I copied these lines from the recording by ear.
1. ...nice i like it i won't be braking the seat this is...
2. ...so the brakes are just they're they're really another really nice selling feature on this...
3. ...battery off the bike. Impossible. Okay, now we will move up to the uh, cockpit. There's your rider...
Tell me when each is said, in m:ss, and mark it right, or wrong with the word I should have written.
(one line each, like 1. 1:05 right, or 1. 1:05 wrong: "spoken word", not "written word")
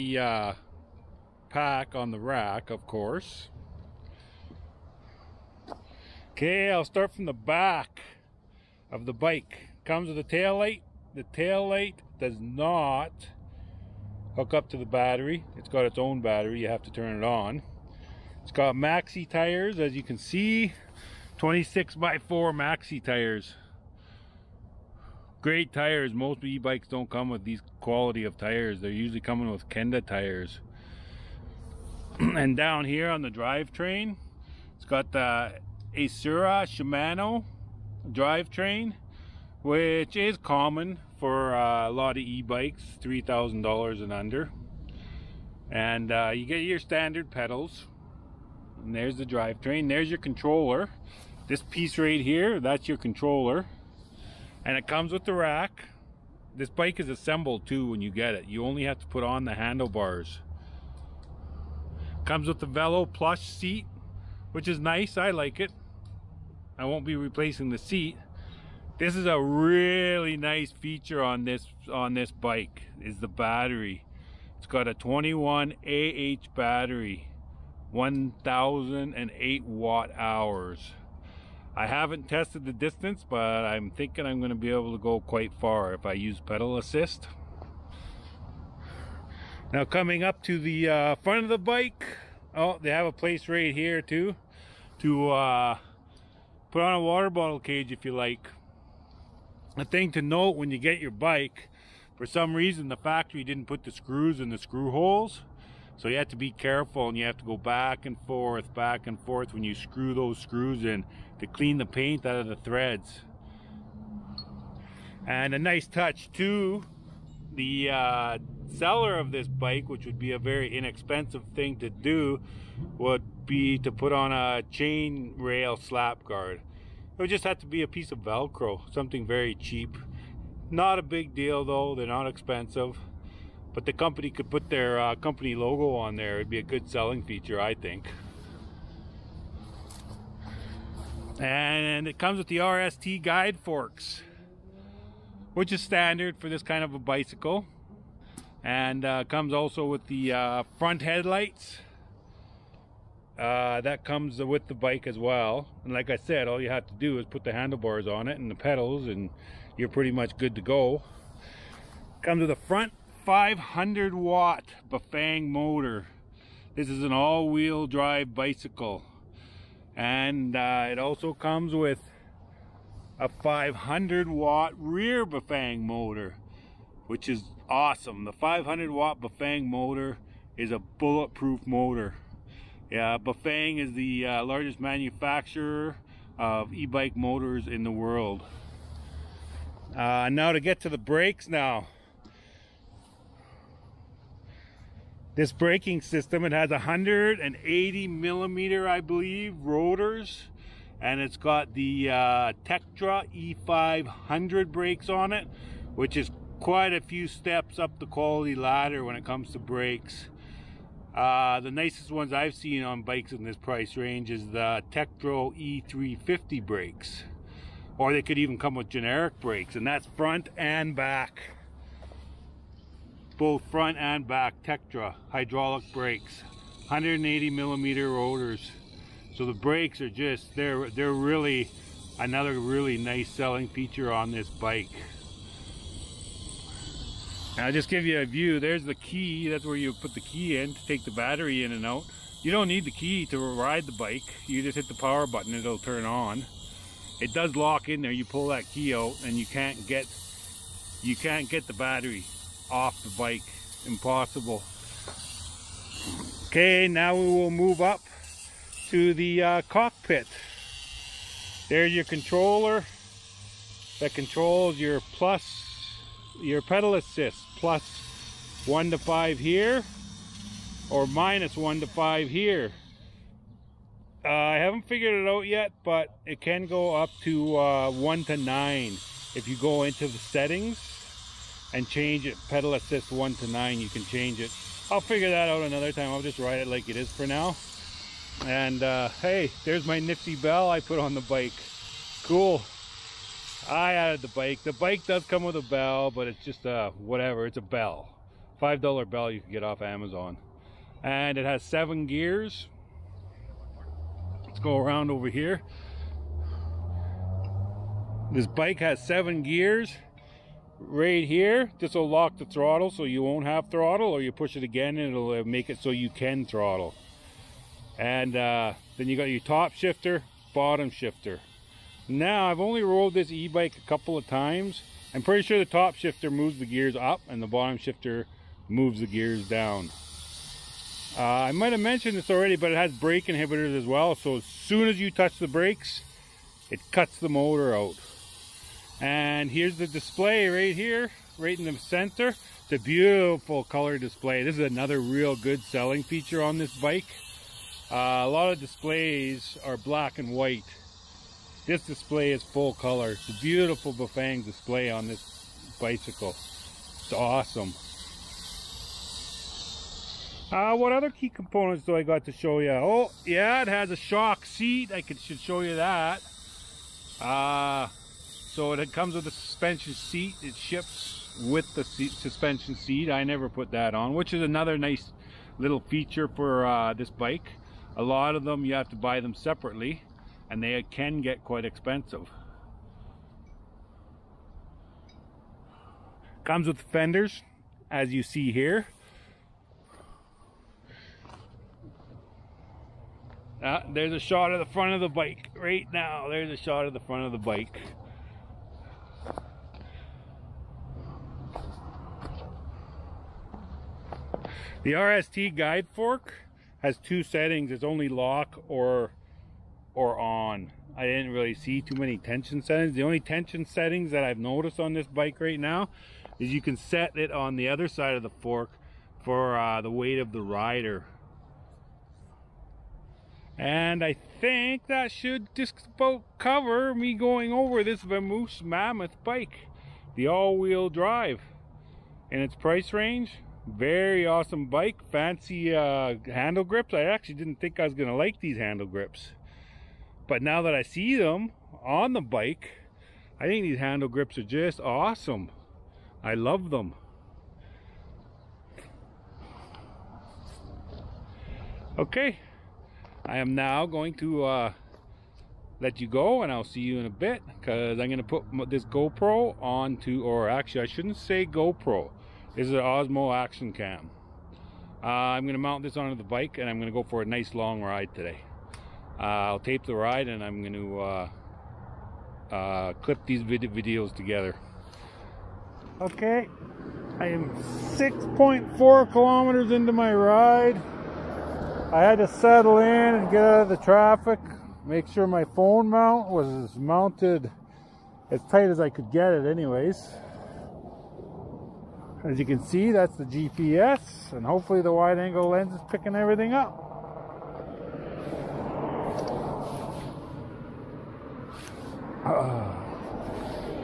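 1. 1:04 wrong: "replacing", not "braking"
2. 3:49 right
3. 4:11 wrong: "controller", not "rider".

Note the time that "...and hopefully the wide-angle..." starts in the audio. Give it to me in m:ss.
8:14.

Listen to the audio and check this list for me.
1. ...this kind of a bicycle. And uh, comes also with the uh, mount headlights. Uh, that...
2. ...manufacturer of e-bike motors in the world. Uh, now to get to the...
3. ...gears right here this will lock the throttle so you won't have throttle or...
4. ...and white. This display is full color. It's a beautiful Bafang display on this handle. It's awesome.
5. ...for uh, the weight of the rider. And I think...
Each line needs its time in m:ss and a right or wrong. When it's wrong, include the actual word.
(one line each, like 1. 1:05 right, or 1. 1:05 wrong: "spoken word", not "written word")
1. 2:26 wrong: "front", not "mount"
2. 3:04 right
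3. 5:09 right
4. 5:50 wrong: "bicycle", not "handle"
5. 6:59 right.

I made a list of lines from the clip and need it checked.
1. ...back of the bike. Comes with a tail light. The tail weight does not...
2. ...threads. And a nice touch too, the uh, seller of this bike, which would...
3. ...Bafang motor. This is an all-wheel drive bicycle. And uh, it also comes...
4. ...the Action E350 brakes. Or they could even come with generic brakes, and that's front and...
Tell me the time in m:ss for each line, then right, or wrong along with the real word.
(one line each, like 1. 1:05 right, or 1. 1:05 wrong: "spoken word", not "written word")
1. 0:07 wrong: "light", not "weight"
2. 1:52 right
3. 2:44 right
4. 3:34 wrong: "Tektro", not "Action".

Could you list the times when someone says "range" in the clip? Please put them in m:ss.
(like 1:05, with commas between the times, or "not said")
3:33, 7:12.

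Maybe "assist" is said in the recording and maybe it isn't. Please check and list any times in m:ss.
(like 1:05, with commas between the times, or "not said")
1:26, 4:26, 4:42.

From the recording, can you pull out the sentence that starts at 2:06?
It would just have to be a piece of Velcro, something very cheap.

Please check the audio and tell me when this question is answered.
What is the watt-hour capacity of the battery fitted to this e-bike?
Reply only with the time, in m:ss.
1:17.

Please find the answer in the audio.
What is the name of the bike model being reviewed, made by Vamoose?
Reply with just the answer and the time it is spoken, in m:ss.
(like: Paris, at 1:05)
Mammoth, at 7:08.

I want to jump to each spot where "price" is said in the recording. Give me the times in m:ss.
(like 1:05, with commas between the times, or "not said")
3:33, 7:12.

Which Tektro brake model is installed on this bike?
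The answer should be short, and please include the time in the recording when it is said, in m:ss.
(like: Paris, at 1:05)
Tektro E500, at 3:22.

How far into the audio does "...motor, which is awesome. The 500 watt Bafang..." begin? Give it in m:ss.
2:55.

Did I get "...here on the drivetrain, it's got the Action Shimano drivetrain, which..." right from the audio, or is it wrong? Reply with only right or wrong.
wrong.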